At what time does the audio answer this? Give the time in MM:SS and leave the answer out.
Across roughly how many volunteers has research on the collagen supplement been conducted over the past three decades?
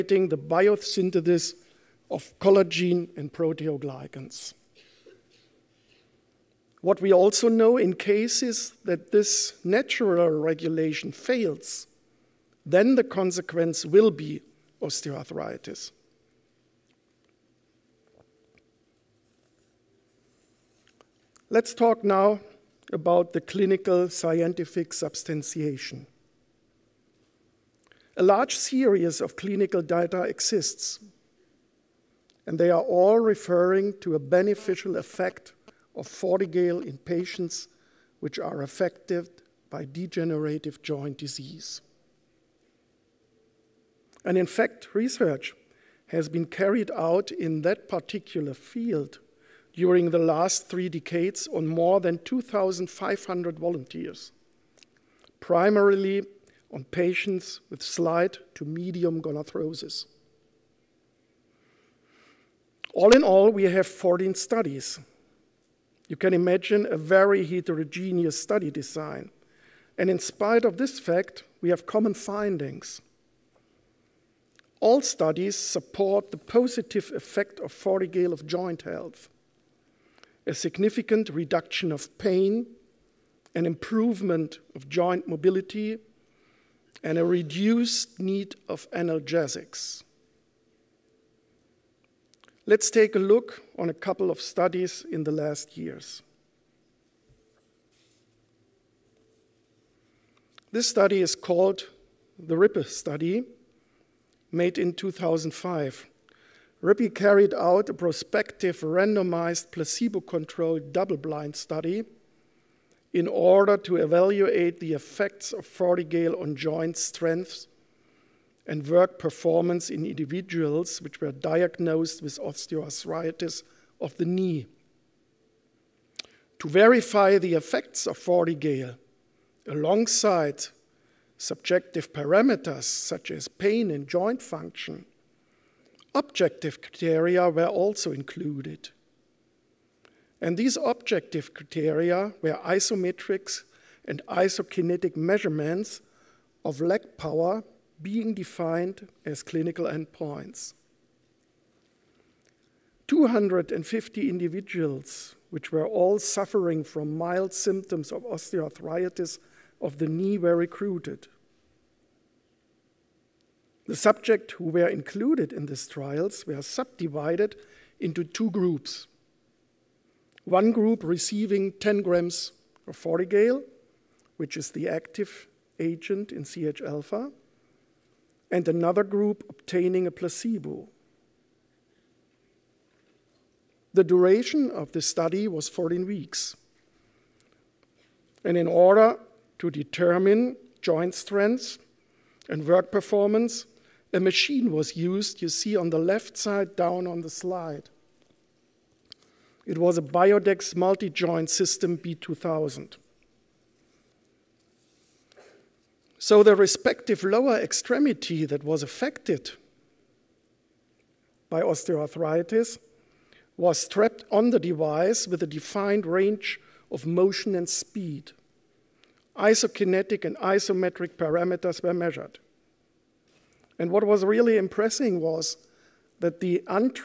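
00:52.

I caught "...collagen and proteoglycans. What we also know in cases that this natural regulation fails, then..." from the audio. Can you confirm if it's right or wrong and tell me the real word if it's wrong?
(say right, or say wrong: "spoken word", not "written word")
right.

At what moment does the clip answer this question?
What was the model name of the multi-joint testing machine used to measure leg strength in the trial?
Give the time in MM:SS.
03:20.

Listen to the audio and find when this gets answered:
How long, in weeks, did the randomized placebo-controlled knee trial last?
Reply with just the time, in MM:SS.
03:05.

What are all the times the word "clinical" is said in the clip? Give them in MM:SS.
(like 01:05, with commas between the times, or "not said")
00:23, 00:29, 02:29.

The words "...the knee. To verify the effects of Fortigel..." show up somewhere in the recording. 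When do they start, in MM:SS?
02:04.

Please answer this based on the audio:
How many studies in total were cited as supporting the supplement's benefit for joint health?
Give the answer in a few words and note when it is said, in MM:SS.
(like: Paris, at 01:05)
14, at 01:03.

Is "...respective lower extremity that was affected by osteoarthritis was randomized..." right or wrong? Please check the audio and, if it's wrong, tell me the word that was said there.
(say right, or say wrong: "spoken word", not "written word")
wrong: "strapped", not "randomized".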